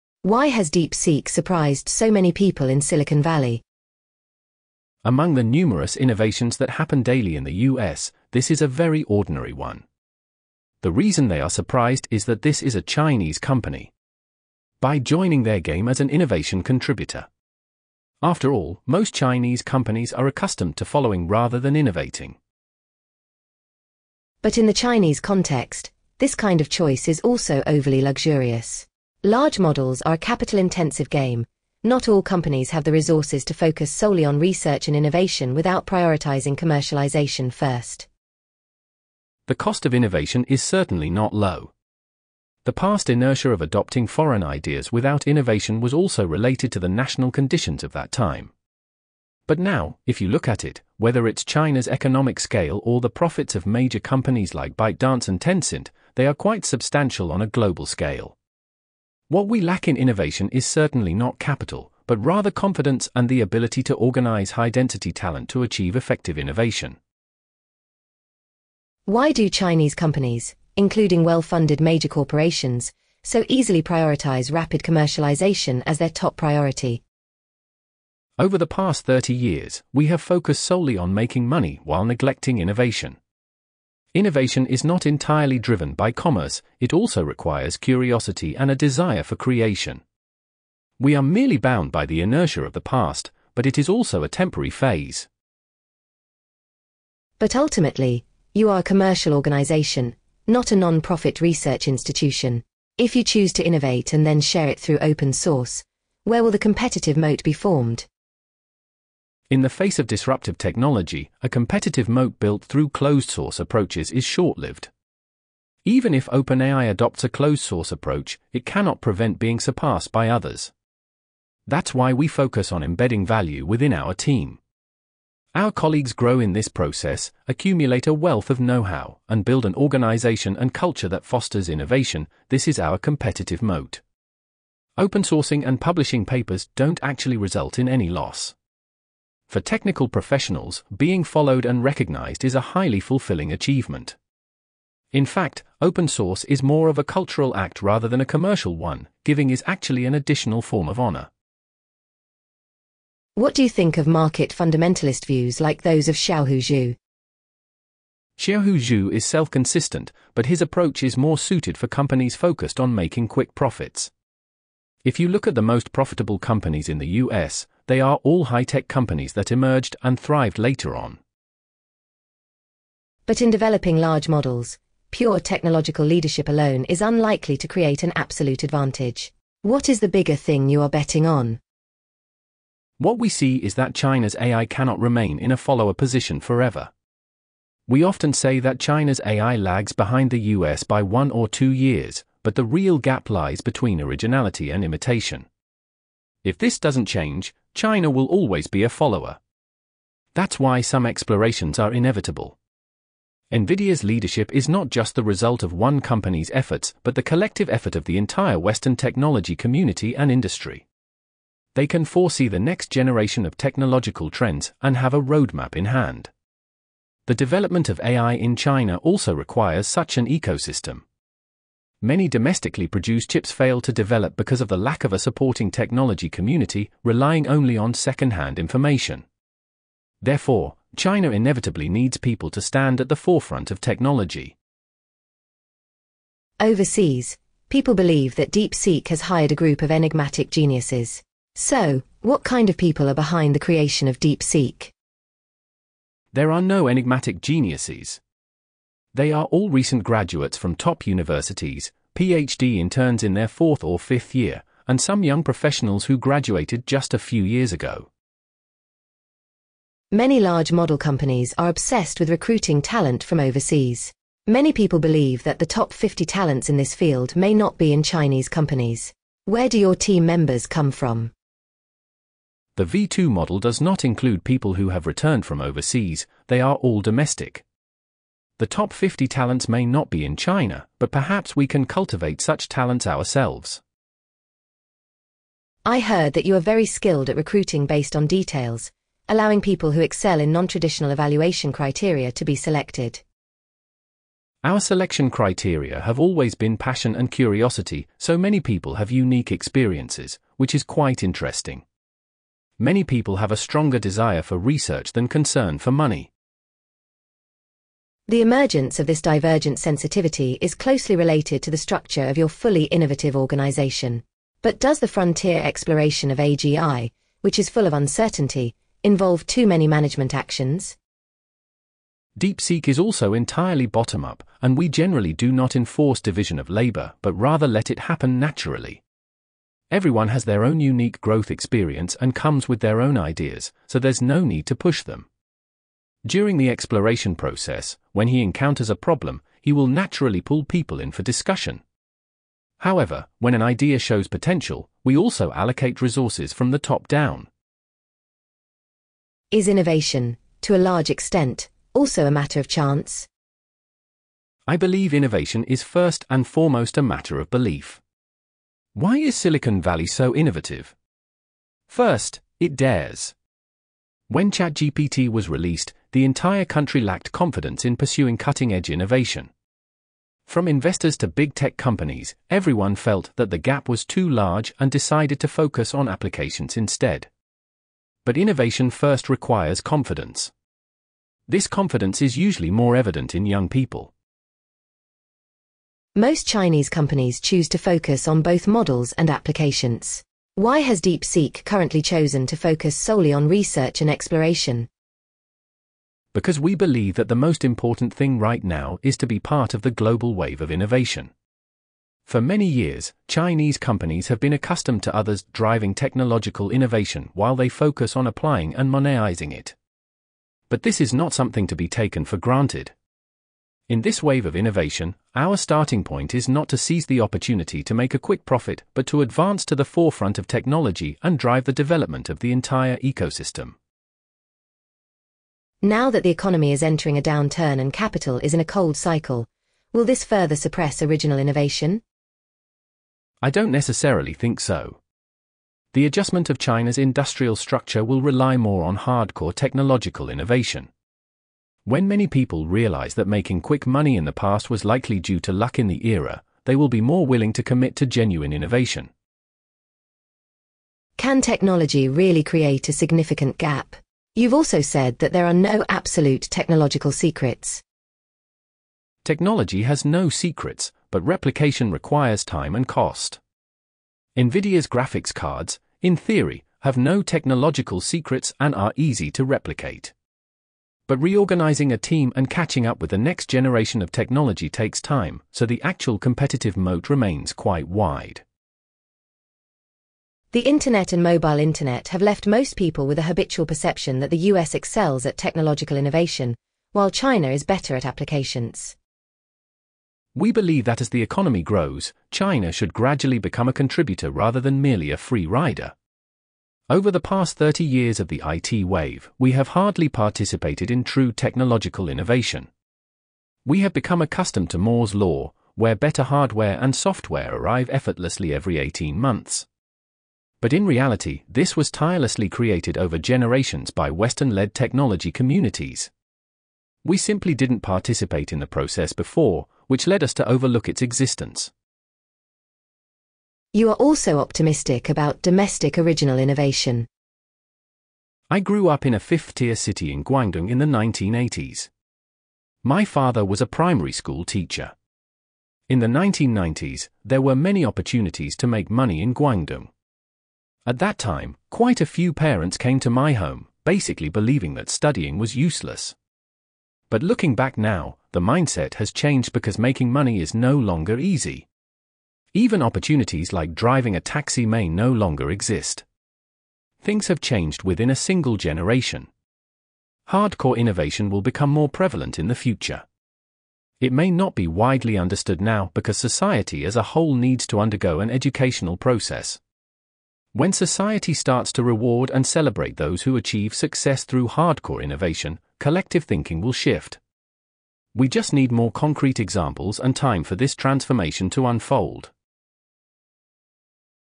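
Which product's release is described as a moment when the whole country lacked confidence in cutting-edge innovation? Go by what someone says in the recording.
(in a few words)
ChatGPT.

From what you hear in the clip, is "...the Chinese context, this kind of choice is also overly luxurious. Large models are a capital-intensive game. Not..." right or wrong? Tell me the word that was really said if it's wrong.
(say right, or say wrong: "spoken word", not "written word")
right.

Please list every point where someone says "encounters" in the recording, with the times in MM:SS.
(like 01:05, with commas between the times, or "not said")
05:38.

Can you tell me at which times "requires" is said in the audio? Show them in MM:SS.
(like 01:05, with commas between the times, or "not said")
01:27, 03:39, 06:19, 07:41.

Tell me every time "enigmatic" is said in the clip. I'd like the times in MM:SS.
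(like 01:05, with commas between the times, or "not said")
03:59, 04:06.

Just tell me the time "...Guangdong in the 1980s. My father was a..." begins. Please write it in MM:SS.
08:50.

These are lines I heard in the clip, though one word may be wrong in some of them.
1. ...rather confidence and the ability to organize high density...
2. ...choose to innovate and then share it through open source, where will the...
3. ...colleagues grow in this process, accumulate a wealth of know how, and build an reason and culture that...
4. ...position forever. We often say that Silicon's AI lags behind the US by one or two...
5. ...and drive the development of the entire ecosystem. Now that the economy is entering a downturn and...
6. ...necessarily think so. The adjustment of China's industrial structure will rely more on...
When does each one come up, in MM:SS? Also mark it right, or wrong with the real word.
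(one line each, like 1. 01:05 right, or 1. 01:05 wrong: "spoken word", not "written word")
1. 01:02 right
2. 01:43 right
3. 02:05 wrong: "organization", not "reason"
4. 03:05 wrong: "China", not "Silicon"
5. 07:01 right
6. 07:13 right.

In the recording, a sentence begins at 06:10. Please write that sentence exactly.
From investors to big tech companies, everyone felt that the gap was too large and decided to focus on applications instead.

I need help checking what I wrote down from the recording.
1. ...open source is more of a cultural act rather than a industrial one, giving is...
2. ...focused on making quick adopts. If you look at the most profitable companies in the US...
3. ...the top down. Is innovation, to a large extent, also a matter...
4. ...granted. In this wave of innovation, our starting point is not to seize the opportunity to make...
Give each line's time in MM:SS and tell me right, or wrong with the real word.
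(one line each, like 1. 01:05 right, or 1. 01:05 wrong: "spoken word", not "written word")
1. 02:25 wrong: "commercial", not "industrial"
2. 02:42 wrong: "profits", not "adopts"
3. 05:46 right
4. 06:52 right.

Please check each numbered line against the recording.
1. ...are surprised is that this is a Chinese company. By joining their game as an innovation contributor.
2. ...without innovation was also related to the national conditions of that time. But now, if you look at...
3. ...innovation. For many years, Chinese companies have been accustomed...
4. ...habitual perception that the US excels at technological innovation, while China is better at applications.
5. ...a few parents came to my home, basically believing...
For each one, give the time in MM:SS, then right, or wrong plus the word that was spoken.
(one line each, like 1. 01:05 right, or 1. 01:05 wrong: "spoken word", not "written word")
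1. 00:11 right
2. 00:44 right
3. 06:40 right
4. 08:03 right
5. 09:02 right.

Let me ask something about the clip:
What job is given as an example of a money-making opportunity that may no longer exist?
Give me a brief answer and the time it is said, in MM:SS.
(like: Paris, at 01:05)
driving a taxi, at 09:13.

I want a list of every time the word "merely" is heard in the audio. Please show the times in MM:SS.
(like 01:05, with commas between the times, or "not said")
01:31, 08:14.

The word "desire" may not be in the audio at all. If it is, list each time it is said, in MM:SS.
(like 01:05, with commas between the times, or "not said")
01:28, 05:03.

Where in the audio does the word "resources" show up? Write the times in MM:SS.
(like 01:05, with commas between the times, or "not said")
00:32, 05:46.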